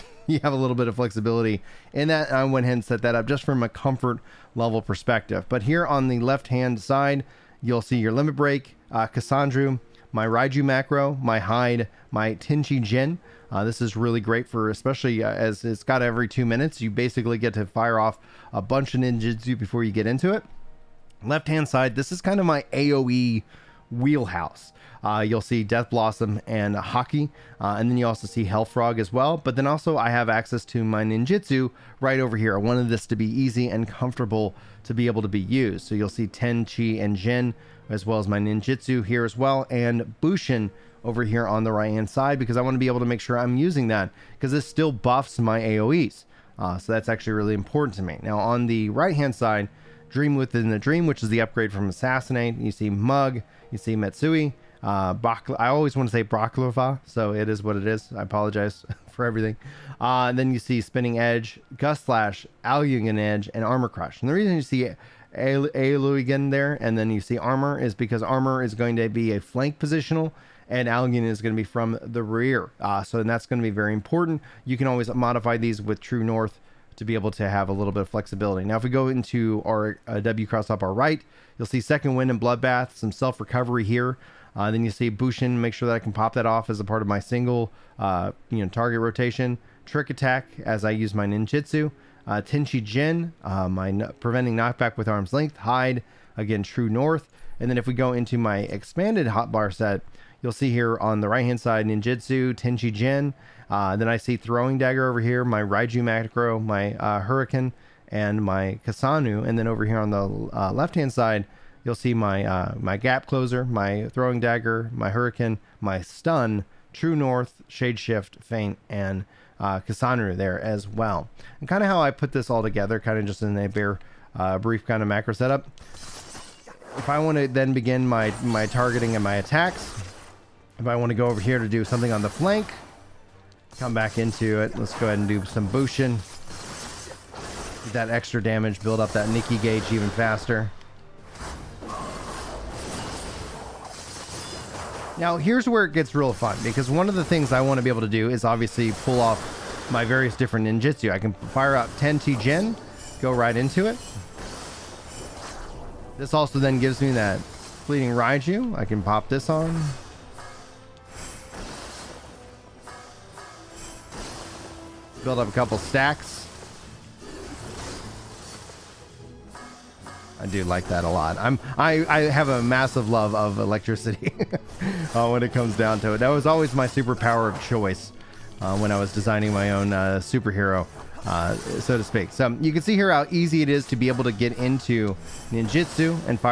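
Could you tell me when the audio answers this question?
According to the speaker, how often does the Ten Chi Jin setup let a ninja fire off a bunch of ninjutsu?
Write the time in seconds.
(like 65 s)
16 s.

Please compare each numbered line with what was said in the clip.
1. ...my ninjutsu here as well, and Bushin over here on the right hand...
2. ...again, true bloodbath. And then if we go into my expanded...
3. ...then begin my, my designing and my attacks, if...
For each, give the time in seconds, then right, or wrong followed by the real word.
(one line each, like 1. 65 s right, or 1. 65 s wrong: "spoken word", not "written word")
1. 38 s right
2. 96 s wrong: "north", not "bloodbath"
3. 127 s wrong: "targeting", not "designing".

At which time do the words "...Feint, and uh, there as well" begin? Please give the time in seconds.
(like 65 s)
118 s.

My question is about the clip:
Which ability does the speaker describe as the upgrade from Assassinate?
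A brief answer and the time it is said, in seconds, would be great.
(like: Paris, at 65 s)
Dream Within the Dream, at 50 s.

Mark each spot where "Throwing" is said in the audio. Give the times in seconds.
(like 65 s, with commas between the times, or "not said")
104 s, 114 s.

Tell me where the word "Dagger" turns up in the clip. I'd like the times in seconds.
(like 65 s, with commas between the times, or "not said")
104 s, 114 s.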